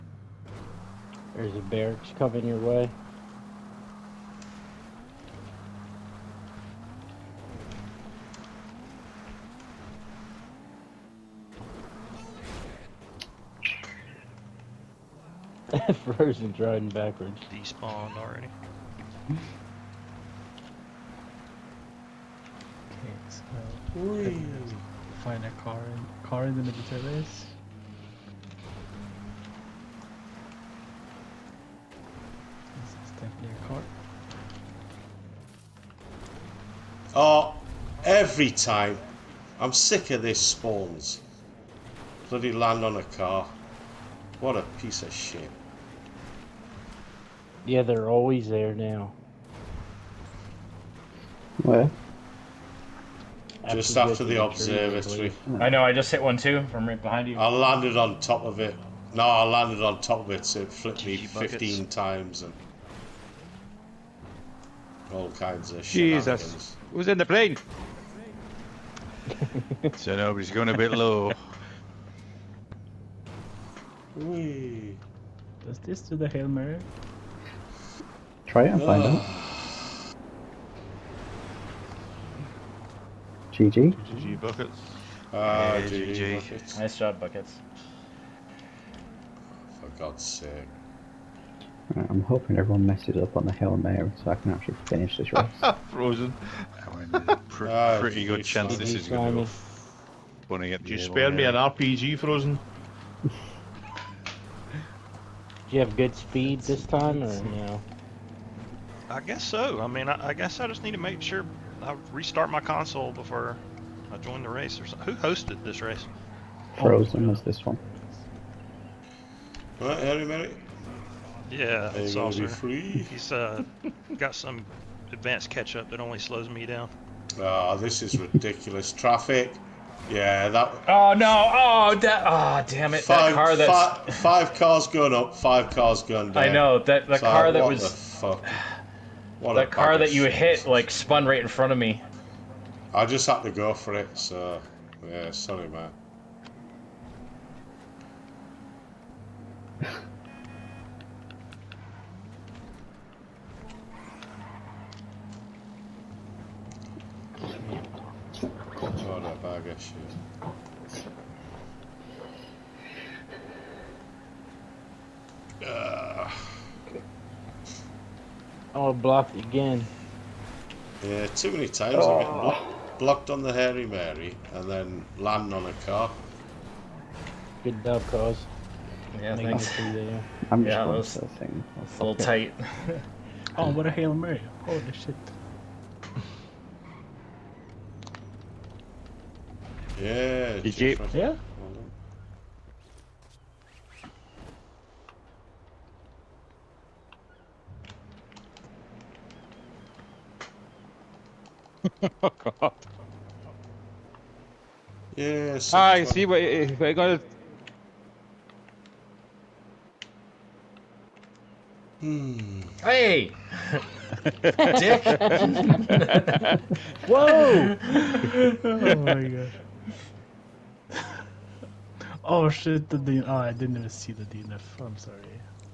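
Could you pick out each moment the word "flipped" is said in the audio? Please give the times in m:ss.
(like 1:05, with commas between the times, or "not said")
1:00.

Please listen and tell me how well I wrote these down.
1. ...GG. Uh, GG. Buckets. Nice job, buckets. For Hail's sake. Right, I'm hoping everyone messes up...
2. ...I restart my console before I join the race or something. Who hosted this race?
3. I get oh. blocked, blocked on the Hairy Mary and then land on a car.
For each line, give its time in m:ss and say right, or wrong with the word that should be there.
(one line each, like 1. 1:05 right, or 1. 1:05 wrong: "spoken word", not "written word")
1. 1:25 wrong: "God", not "Hail"
2. 1:51 right
3. 2:52 right.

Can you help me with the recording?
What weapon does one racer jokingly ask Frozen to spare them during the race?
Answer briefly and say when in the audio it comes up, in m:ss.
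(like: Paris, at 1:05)
RPG, at 1:41.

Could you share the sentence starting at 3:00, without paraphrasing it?
I'm just yeah, that was that thing.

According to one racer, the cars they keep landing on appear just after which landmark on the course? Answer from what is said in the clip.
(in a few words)
The observatory.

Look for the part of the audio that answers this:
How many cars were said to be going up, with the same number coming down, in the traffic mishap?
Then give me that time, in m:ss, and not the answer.
2:14.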